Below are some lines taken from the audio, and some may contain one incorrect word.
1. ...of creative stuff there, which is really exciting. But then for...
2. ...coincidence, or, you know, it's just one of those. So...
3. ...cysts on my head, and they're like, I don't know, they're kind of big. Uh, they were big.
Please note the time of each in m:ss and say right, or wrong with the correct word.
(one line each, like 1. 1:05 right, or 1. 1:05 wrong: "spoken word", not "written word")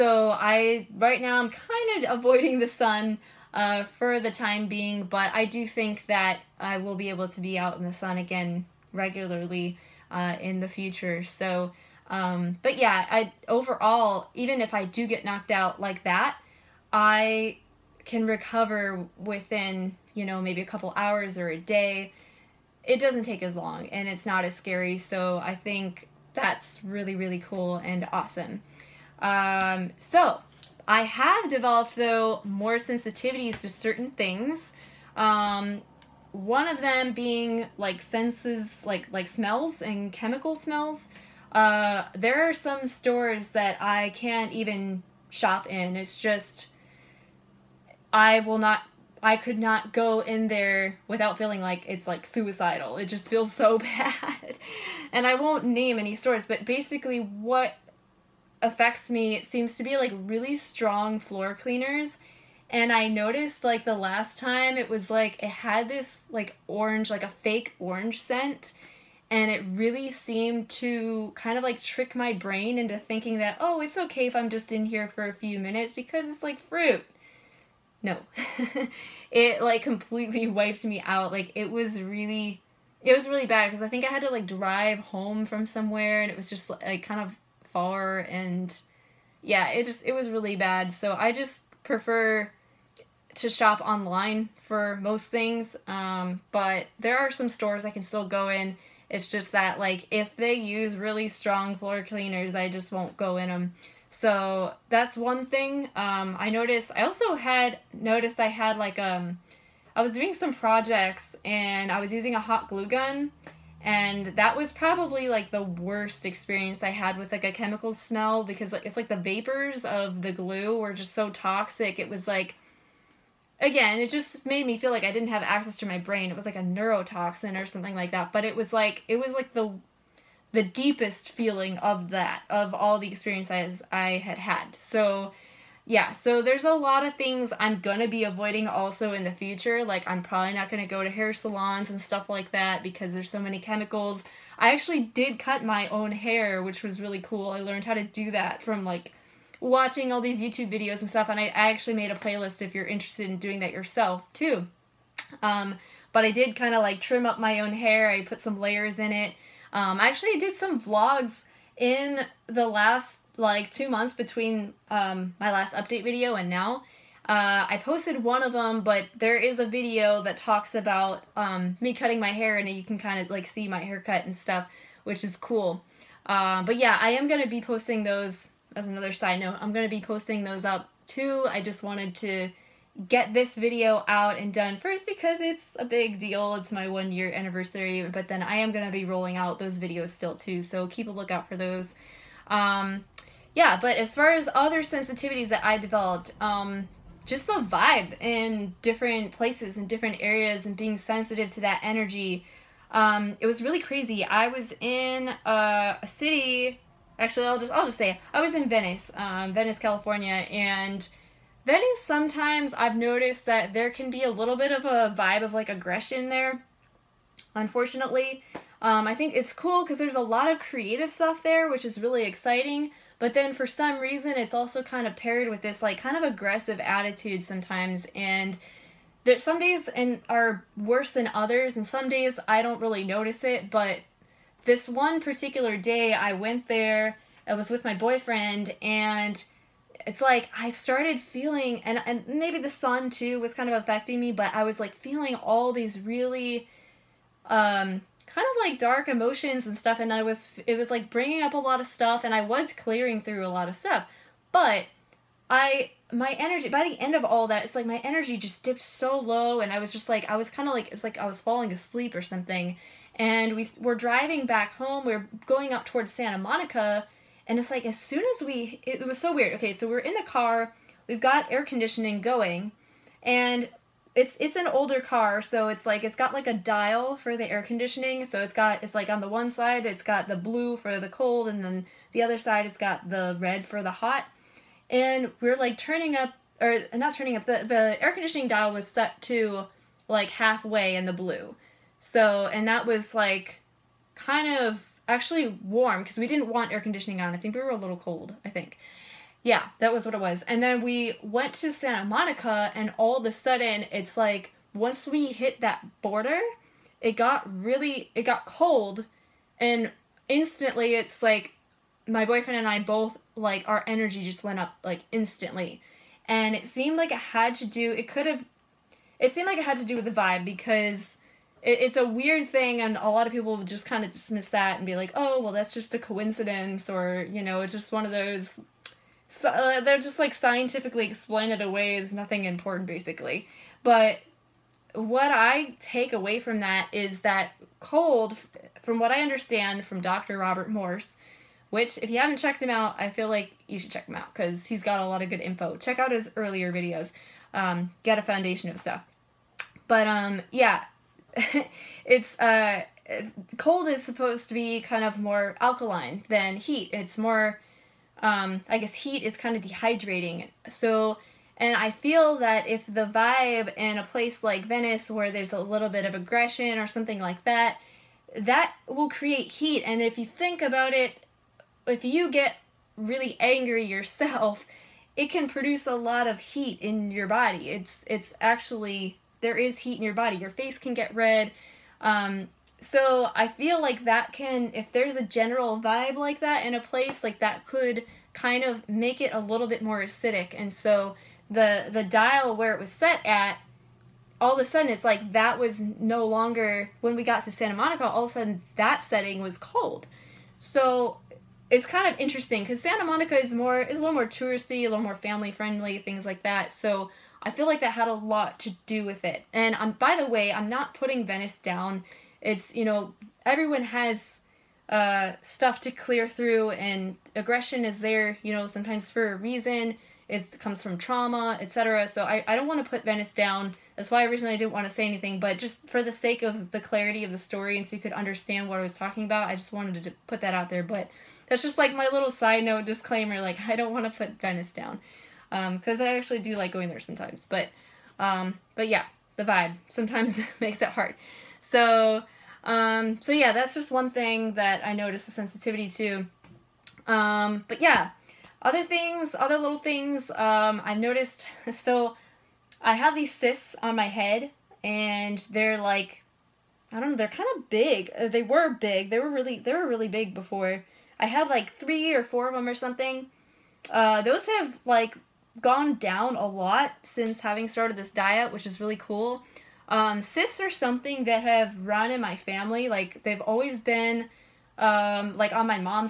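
1. 3:40 right
2. 5:25 right
3. 7:33 right.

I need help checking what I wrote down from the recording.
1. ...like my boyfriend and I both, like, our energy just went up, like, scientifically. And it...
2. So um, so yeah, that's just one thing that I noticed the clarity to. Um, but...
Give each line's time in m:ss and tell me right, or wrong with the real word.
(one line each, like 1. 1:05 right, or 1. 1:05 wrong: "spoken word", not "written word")
1. 5:11 wrong: "instantly", not "scientifically"
2. 7:21 wrong: "sensitivity", not "clarity".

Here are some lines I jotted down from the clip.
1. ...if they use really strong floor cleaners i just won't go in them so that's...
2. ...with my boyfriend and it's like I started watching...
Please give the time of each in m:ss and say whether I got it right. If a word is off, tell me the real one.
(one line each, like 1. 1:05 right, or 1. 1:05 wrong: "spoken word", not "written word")
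1. 1:40 right
2. 3:57 wrong: "feeling", not "watching".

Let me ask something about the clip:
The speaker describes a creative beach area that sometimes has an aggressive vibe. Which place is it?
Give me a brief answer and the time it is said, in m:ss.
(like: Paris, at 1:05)
Venice, California, at 3:29.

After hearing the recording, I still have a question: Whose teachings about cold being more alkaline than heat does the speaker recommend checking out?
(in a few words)
Dr. Robert Morse.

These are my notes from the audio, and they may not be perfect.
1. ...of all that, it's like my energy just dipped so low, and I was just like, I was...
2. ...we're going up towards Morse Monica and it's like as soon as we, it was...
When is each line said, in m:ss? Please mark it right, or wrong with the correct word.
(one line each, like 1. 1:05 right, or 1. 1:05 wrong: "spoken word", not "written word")
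1. 4:17 right
2. 4:25 wrong: "Santa", not "Morse".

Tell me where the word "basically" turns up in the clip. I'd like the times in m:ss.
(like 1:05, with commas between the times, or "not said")
0:56, 5:32.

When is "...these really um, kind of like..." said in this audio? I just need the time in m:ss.
4:05.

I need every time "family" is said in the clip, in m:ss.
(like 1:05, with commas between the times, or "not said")
6:45, 7:52.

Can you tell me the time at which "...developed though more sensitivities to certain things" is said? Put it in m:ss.
0:31.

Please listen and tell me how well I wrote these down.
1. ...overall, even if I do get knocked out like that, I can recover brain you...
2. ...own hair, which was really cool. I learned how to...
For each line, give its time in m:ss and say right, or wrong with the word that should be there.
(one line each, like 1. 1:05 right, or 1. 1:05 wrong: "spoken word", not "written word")
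1. 0:13 wrong: "within", not "brain"
2. 2:25 right.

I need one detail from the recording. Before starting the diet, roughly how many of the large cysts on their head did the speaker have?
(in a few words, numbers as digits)
3 or 4.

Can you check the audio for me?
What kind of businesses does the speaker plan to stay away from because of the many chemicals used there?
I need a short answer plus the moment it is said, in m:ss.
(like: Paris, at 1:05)
hair salons, at 2:21.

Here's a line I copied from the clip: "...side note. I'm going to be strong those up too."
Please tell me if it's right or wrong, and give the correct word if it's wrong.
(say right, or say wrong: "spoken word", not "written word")
wrong: "posting", not "strong".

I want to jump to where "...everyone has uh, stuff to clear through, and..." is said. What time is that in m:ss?
6:53.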